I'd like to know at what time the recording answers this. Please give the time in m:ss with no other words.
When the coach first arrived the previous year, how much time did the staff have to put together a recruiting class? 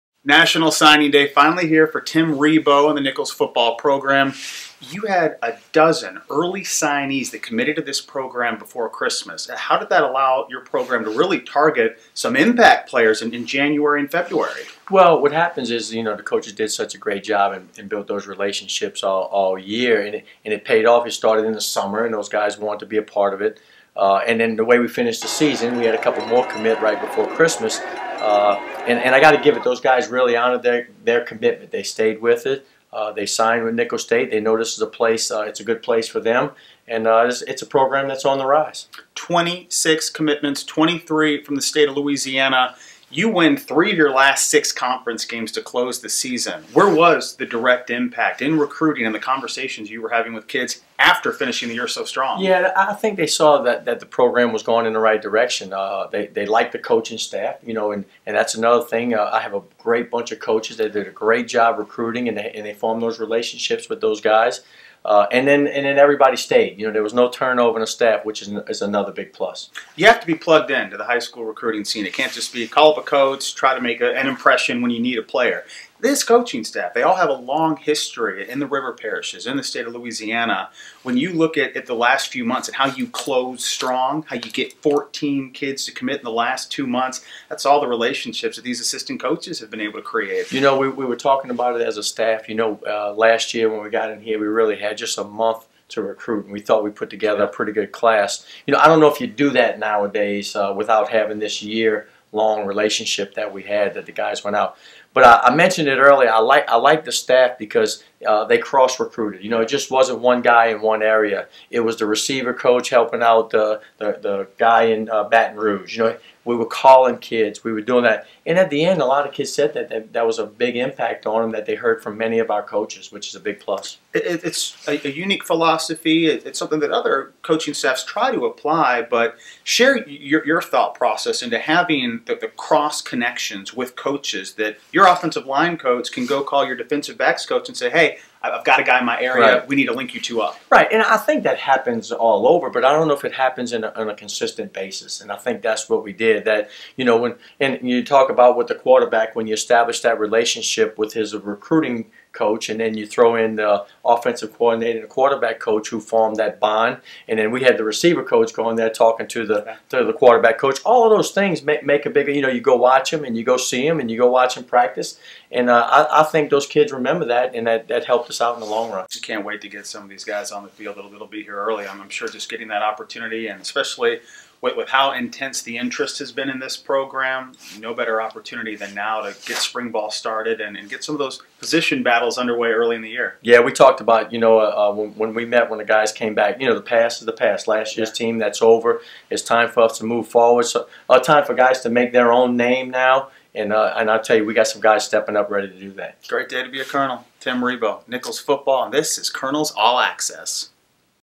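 1:34.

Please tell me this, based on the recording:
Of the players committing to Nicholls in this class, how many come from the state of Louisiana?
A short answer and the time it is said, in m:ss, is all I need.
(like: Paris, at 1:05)
23, at 0:40.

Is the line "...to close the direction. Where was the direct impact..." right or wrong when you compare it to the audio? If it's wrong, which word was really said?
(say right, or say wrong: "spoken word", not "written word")
wrong: "season", not "direction".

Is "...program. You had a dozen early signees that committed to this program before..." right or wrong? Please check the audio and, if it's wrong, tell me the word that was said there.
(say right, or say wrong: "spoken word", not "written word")
right.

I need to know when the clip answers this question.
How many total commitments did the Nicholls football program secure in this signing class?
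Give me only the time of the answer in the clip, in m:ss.
0:39.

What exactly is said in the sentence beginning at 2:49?
Just can't wait to get some of these guys on the field.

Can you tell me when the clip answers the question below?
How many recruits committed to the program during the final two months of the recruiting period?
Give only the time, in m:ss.
1:24.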